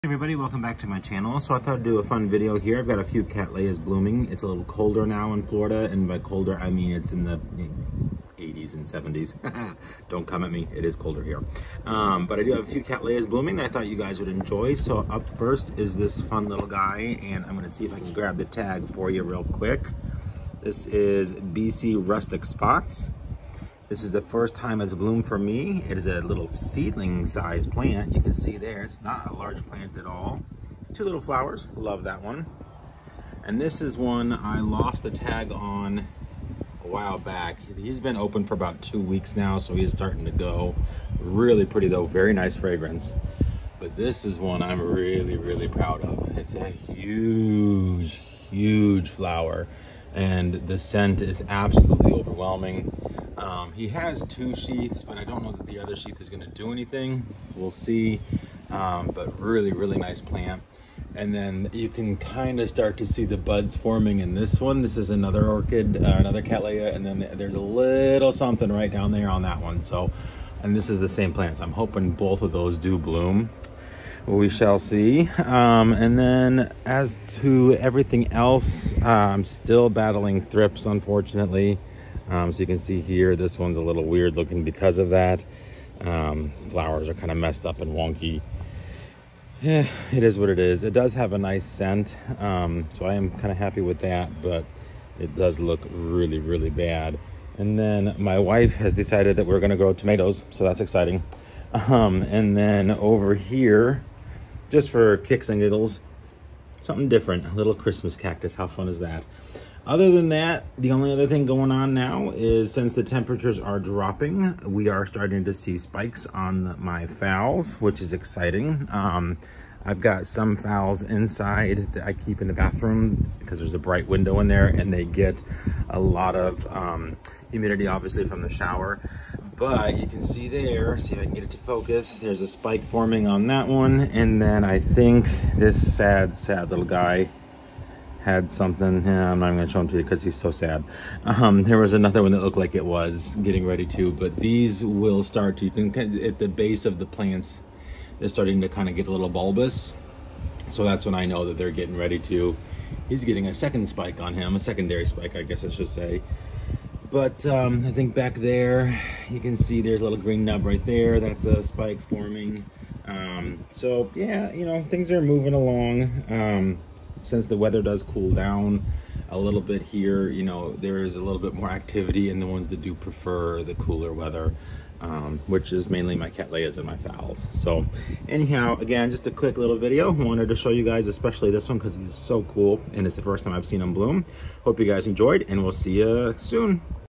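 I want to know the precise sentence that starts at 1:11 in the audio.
So I'm hoping both of those do bloom.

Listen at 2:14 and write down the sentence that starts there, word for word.
And then I think this sad, sad little guy had something.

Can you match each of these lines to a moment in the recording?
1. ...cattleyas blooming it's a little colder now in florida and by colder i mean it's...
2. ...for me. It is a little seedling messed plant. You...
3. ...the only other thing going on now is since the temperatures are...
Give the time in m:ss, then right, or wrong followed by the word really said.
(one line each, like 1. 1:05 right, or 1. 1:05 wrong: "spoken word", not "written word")
1. 0:03 right
2. 0:25 wrong: "sized", not "messed"
3. 1:50 right.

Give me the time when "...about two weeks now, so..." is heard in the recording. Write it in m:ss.
0:38.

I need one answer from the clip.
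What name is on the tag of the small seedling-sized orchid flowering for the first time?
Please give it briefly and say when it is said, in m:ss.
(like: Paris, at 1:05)
Bc Rustic Spots, at 0:21.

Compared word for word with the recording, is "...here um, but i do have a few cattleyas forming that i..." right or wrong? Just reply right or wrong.
wrong.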